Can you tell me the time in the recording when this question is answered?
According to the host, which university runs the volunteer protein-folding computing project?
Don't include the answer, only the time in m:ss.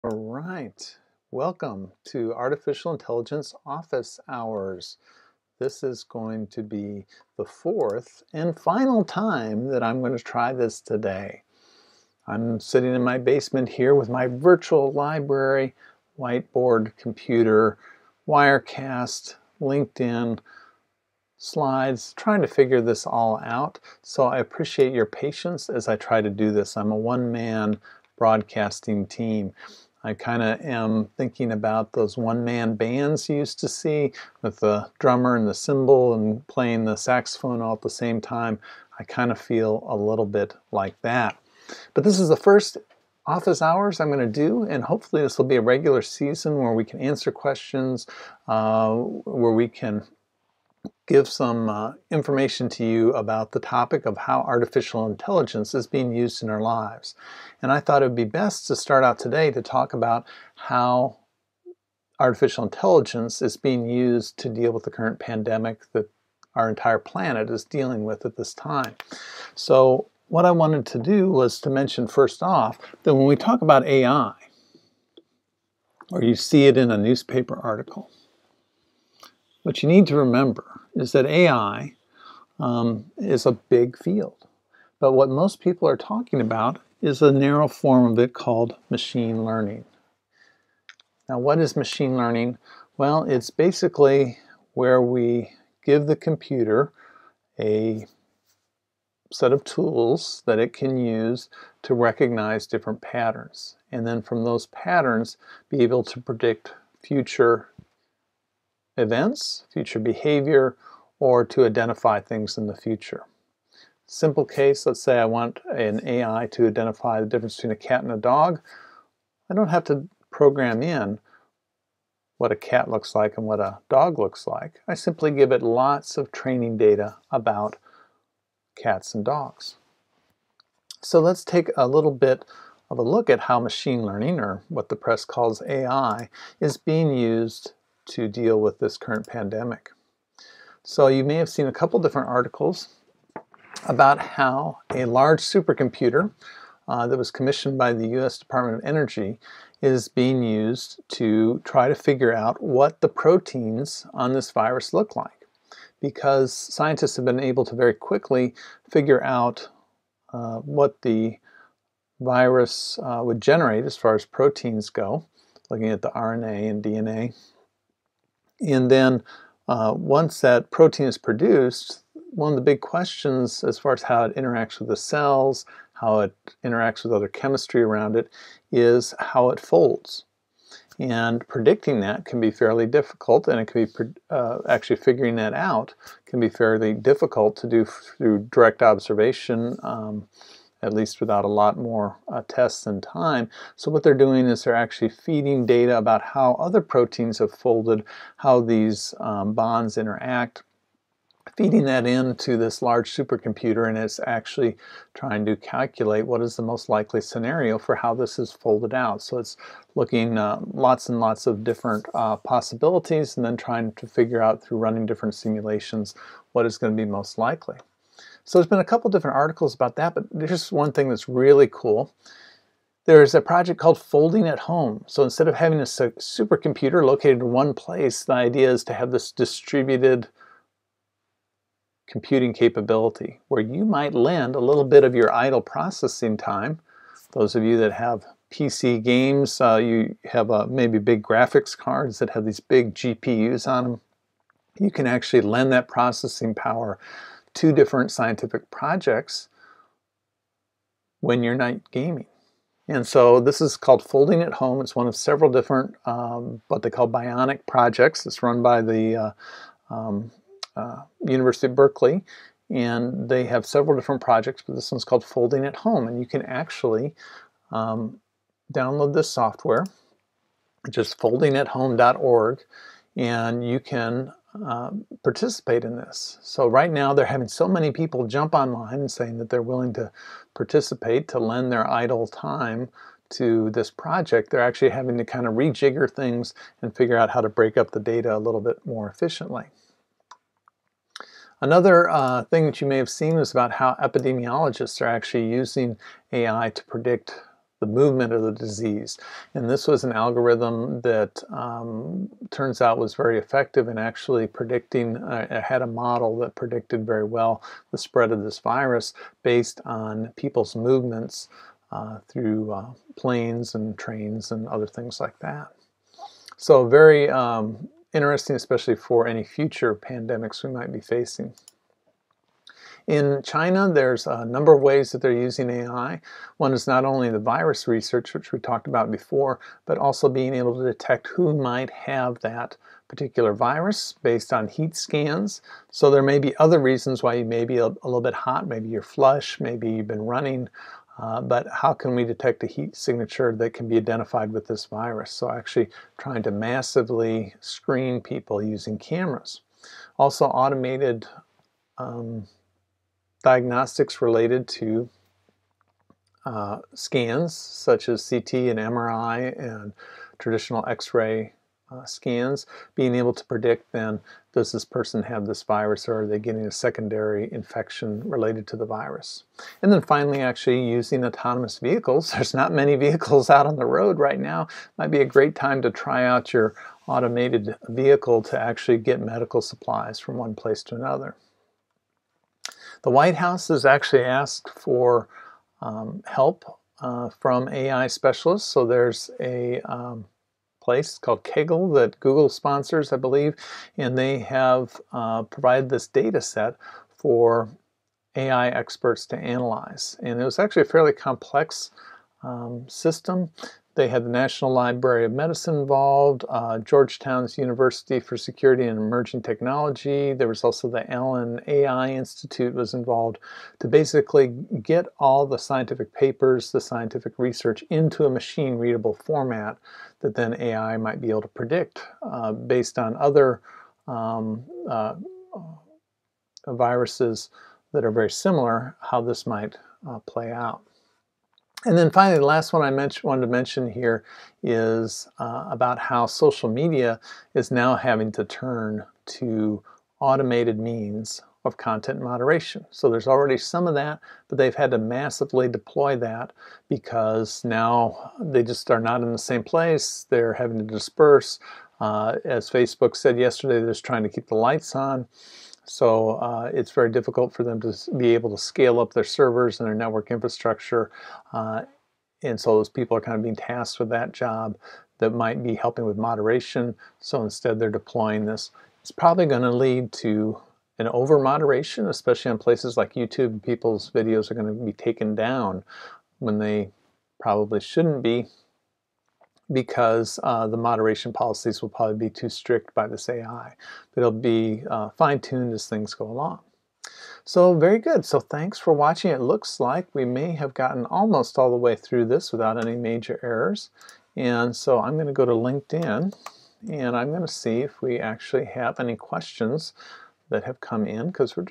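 4:21.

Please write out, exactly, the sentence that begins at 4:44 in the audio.
They're actually having to kind of rejigger things and figure out how to break up the data a little bit more efficiently.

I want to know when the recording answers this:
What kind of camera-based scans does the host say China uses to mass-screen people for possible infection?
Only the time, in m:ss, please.
5:34.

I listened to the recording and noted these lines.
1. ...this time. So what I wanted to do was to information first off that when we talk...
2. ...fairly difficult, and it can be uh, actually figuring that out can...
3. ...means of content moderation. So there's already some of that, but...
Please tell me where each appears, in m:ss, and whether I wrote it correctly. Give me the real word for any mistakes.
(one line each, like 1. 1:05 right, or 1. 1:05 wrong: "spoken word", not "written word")
1. 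1:08 wrong: "mention", not "information"
2. 3:02 right
3. 7:20 right.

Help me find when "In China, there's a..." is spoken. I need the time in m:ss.
5:23.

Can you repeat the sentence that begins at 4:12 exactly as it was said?
And so this is called Folding at Home.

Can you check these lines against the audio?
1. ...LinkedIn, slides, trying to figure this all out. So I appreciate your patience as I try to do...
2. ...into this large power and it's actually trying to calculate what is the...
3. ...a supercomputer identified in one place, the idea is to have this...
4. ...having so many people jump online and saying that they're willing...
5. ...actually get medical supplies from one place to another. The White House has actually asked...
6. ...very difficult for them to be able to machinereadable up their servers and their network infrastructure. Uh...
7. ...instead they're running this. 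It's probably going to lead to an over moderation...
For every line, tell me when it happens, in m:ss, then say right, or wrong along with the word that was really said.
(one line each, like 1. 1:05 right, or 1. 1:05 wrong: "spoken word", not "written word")
1. 0:19 right
2. 3:22 wrong: "supercomputer", not "power"
3. 3:45 wrong: "located", not "identified"
4. 4:37 right
5. 6:18 right
6. 7:36 wrong: "scale", not "machinereadable"
7. 7:47 wrong: "deploying", not "running".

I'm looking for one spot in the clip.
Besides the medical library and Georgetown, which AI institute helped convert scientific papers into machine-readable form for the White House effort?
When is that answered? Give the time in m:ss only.
6:51.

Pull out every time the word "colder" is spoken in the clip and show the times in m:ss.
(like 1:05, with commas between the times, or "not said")
not said.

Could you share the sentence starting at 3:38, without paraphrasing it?
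So there's been a couple different articles about that, but there's one thing that's really cool.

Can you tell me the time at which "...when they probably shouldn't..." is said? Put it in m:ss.
7:56.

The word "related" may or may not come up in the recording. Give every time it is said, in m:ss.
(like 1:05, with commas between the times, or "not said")
5:54, 6:08.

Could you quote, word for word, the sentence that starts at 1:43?
And then from those patterns, be able to predict future events, future behavior, or to identify things in the future.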